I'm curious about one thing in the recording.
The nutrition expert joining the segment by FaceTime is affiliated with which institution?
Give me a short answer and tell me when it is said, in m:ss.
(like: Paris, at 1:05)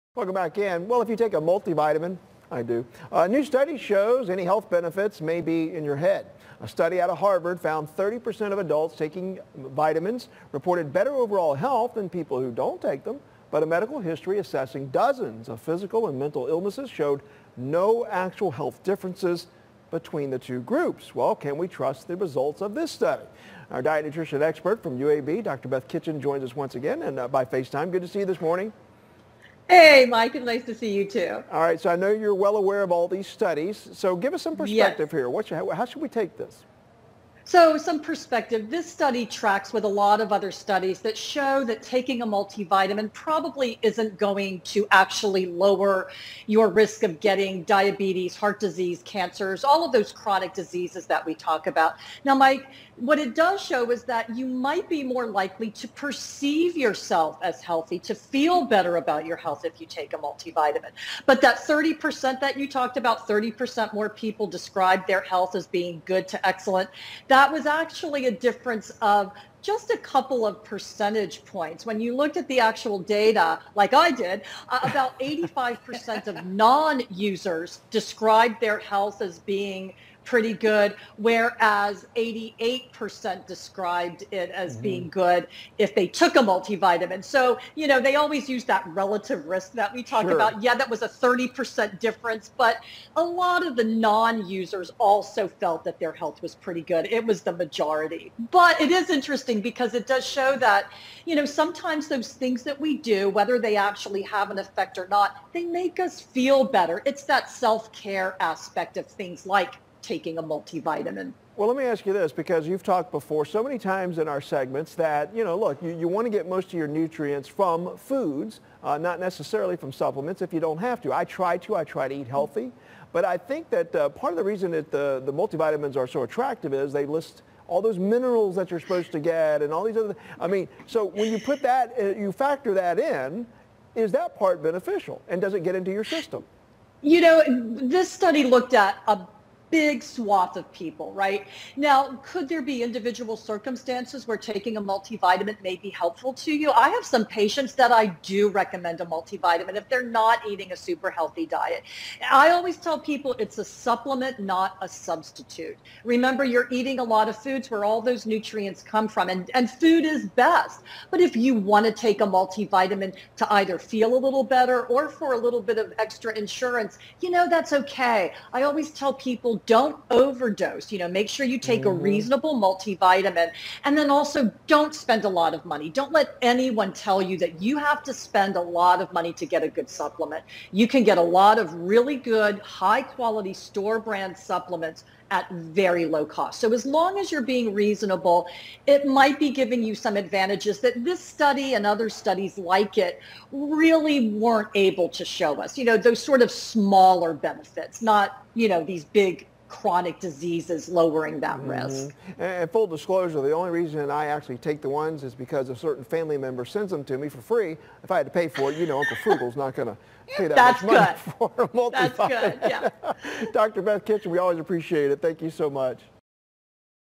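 UAB, at 0:24.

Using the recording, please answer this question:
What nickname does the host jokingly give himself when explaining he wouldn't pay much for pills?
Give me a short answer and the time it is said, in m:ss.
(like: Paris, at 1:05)
Uncle Frugal, at 3:29.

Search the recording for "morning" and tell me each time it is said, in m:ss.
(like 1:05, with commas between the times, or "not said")
0:28.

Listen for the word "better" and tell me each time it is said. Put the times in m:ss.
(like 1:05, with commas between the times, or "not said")
0:10, 0:58, 1:46, 2:44.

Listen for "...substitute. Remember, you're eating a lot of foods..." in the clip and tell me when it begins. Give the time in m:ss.
2:34.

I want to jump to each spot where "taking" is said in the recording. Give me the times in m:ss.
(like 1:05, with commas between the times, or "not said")
0:08, 0:41, 1:50, 2:24.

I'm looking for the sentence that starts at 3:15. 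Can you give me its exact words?
You know, those sort of smaller benefits, not, you know, these big chronic diseases, lowering that mm -hmm.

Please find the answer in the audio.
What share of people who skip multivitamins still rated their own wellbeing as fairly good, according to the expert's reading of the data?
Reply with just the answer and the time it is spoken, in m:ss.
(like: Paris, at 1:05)
85%, at 1:15.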